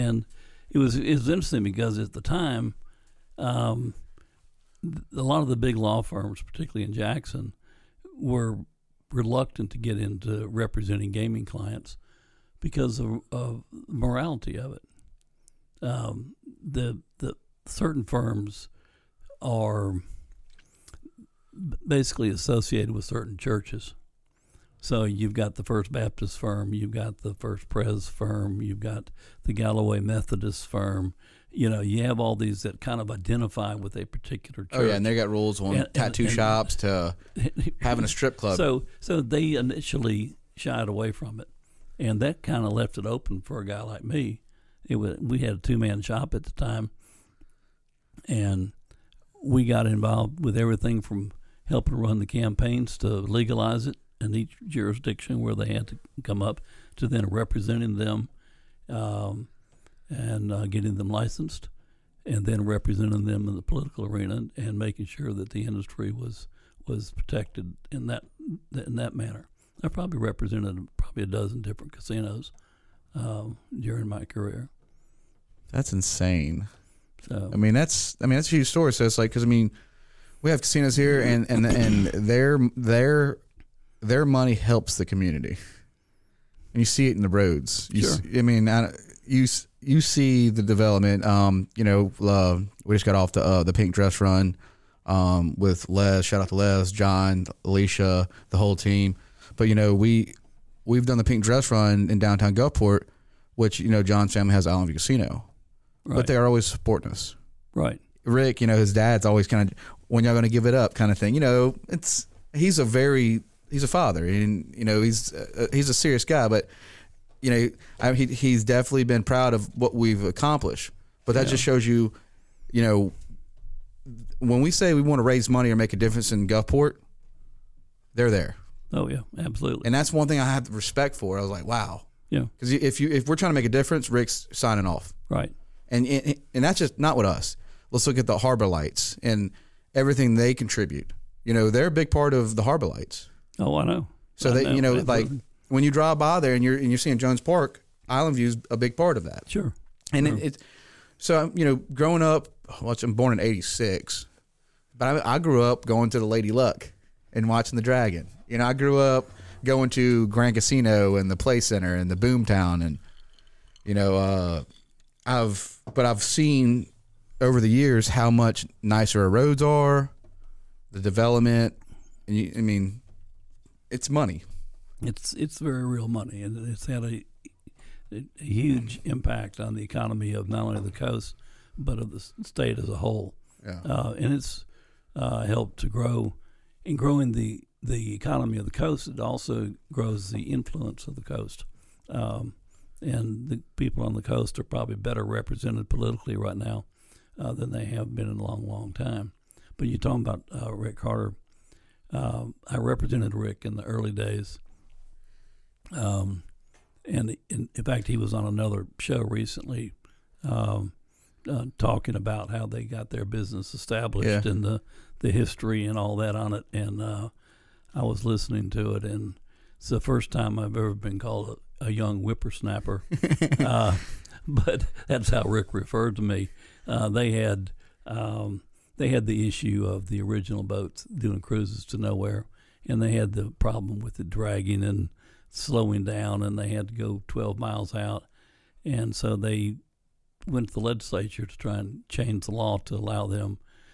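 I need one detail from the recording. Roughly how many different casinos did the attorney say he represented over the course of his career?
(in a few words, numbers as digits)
12.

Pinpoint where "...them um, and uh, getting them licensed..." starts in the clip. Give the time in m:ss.
0:57.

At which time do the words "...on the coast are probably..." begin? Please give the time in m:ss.
3:14.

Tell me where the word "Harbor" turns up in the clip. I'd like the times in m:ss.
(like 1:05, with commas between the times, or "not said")
2:18, 2:22.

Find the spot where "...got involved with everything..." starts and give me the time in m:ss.
0:49.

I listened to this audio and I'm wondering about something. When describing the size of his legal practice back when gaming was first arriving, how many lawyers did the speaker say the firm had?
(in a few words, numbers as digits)
2.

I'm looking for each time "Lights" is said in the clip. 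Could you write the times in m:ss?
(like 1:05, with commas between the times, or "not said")
2:18, 2:22.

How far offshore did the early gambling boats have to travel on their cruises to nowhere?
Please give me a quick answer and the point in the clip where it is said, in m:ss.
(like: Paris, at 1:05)
12 miles, at 3:57.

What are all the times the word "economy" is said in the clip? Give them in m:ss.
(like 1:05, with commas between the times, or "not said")
2:59, 3:08.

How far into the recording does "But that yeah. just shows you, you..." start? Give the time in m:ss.
2:01.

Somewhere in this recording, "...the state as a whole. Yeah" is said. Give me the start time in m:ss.
3:02.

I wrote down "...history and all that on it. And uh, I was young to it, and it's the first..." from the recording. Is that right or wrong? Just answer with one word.
wrong.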